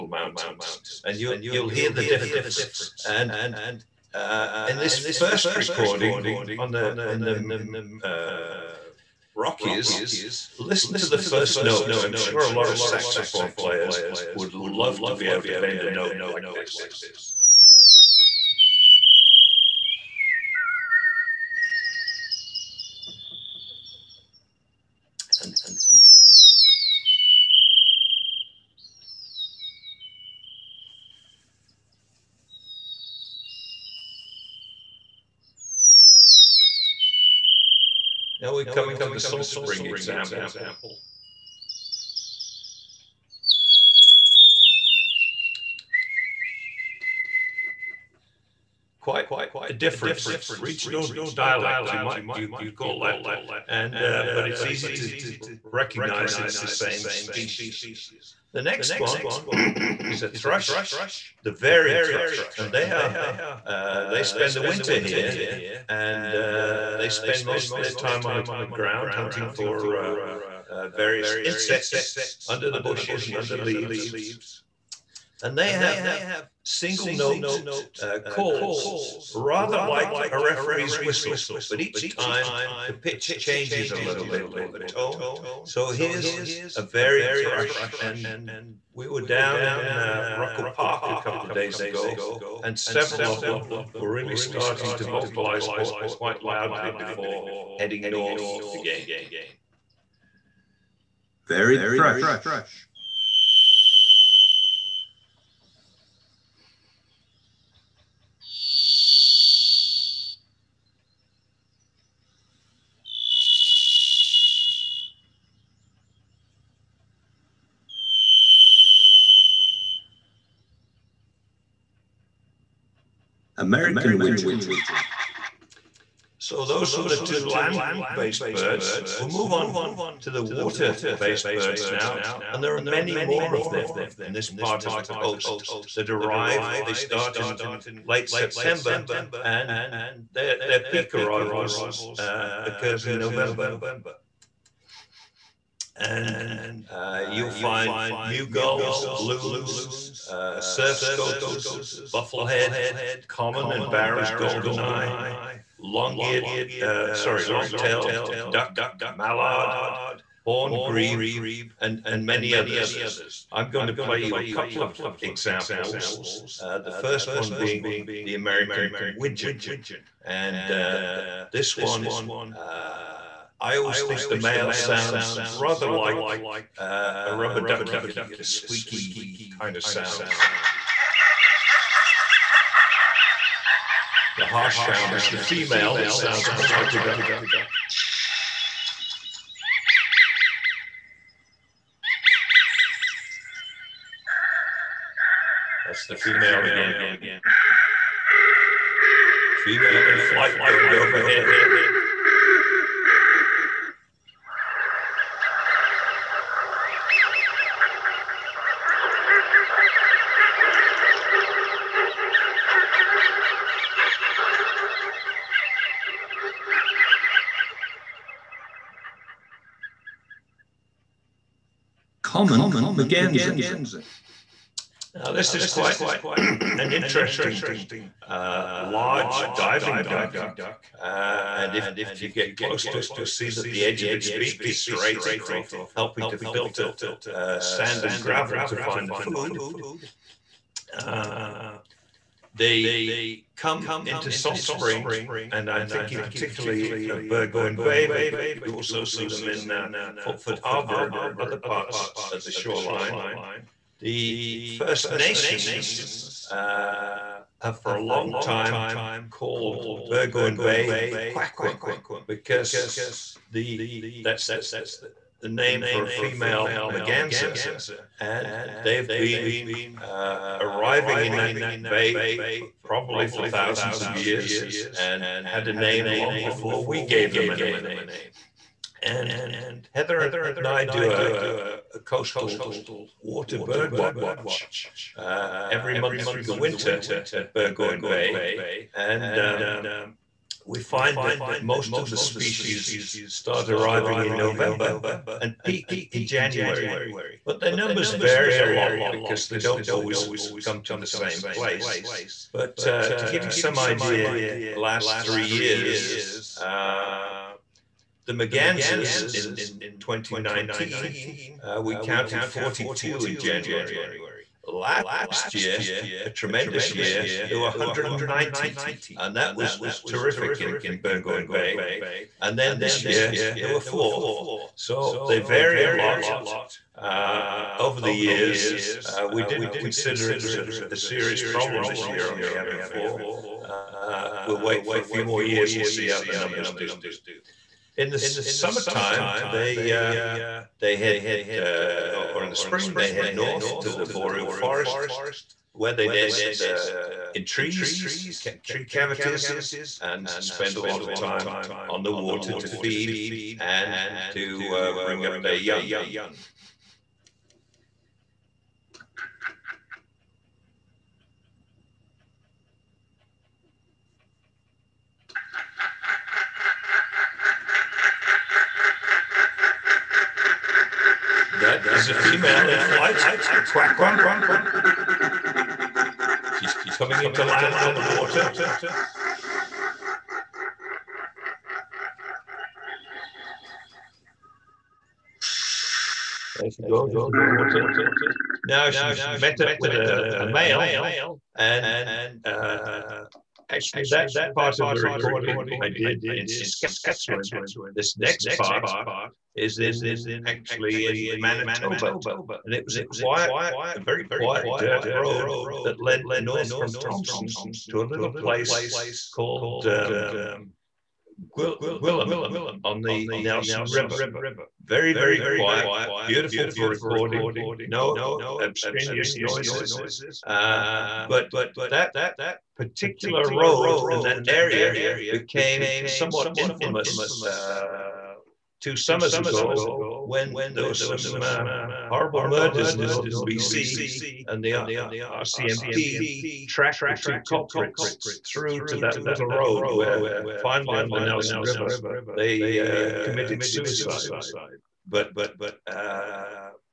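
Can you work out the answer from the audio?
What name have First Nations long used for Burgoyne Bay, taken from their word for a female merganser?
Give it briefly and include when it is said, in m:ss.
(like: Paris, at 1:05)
Quakum, at 4:21.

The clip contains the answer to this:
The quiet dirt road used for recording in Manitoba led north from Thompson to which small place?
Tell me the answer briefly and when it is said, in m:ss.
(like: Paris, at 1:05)
Gillam, at 6:51.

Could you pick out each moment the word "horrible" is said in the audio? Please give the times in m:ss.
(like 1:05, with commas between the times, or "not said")
7:12.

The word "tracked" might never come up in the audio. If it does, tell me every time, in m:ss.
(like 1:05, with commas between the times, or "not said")
7:16.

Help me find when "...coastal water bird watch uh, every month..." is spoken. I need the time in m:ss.
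4:41.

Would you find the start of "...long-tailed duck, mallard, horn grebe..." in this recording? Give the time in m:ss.
2:37.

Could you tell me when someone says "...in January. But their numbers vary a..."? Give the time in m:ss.
4:56.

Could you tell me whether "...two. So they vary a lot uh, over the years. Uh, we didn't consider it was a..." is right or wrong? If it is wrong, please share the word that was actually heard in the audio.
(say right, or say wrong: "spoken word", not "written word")
wrong: "four", not "two".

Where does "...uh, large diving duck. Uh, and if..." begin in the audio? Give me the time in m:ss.
3:48.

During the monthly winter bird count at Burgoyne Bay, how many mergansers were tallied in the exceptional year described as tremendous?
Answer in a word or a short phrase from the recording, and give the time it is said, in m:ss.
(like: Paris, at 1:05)
190, at 5:17.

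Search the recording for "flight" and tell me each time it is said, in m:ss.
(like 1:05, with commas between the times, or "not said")
3:20, 6:12.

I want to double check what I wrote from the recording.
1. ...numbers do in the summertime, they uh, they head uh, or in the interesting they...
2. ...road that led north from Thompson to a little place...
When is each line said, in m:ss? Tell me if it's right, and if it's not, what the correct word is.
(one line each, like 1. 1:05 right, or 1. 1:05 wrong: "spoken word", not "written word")
1. 5:36 wrong: "spring", not "interesting"
2. 6:45 right.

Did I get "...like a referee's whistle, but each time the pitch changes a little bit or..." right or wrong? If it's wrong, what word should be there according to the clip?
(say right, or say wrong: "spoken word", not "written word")
right.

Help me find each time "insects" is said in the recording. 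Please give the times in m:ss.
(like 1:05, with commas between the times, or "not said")
1:11.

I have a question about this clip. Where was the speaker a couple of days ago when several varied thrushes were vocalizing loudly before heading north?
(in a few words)
Ruckle Park.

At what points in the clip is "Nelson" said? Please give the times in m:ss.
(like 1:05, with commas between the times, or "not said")
6:53, 7:21.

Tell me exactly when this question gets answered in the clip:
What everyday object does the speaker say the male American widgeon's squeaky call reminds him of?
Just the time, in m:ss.
2:57.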